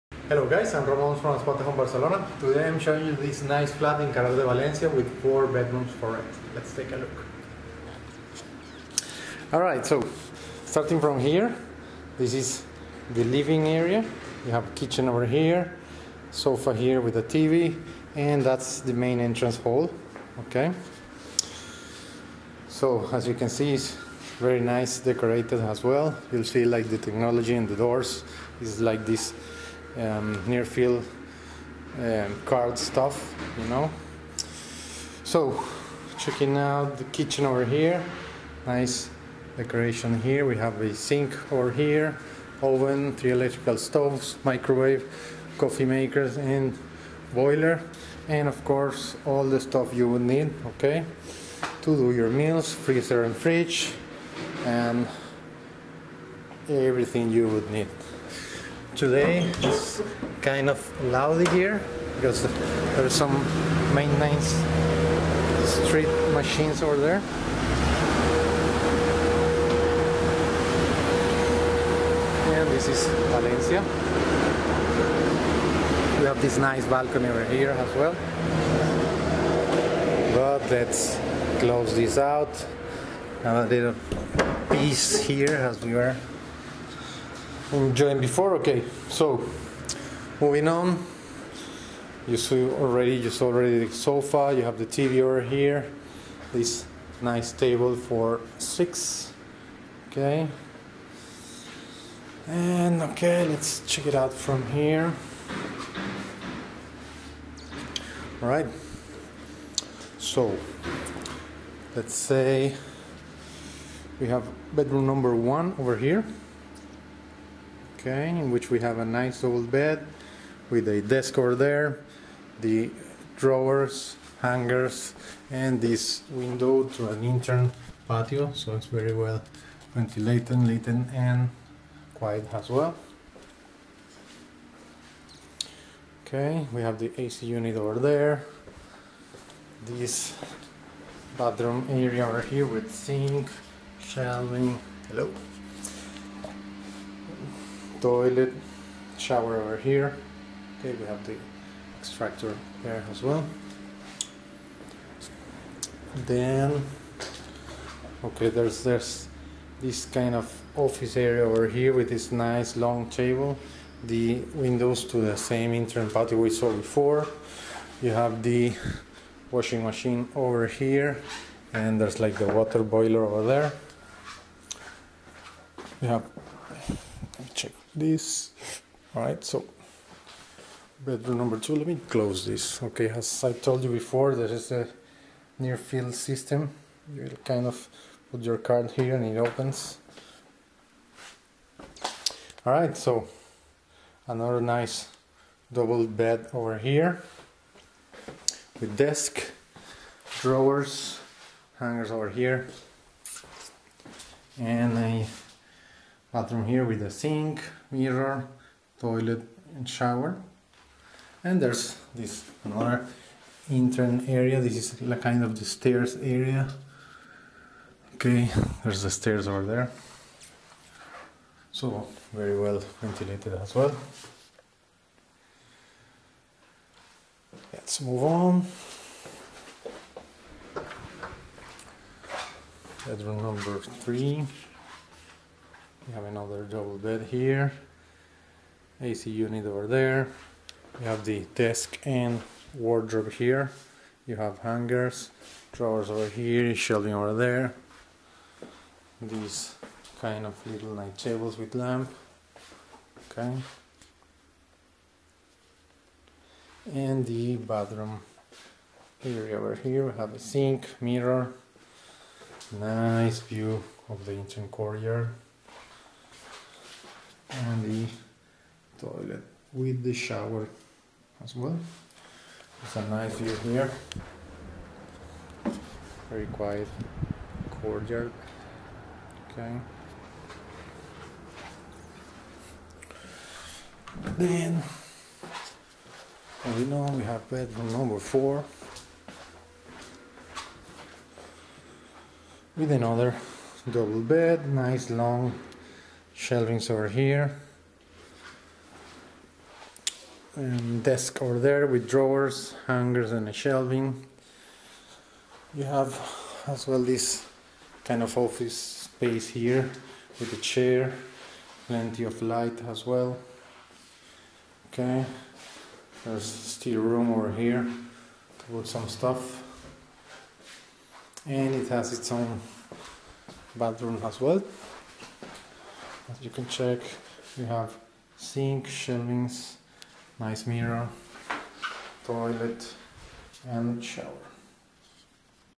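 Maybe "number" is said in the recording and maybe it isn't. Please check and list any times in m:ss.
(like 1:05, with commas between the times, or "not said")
1:55, 3:01, 3:53, 4:47.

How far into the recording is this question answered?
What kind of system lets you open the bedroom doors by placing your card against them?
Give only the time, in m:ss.
3:05.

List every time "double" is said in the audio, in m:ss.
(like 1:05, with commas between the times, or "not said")
3:15, 3:56, 4:53.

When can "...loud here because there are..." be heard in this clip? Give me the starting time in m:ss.
1:01.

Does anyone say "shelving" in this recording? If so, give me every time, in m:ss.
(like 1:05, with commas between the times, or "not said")
2:23, 4:06, 4:56, 5:03, 5:28.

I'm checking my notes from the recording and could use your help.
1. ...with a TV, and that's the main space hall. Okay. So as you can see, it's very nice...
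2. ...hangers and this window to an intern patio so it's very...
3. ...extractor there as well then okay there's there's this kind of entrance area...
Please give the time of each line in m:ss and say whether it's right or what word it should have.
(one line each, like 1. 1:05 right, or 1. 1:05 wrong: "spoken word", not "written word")
1. 0:17 wrong: "entrance", not "space"
2. 2:04 right
3. 2:31 wrong: "office", not "entrance".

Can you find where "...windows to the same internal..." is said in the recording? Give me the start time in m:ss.
2:44.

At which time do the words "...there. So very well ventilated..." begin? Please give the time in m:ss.
3:39.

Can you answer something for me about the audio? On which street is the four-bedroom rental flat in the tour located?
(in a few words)
Carrer de Valencia.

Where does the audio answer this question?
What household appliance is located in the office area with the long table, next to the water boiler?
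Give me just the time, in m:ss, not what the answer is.
2:49.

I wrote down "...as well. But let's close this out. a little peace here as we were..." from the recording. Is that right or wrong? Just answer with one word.
right.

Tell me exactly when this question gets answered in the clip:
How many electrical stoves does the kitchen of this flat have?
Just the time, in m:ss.
0:43.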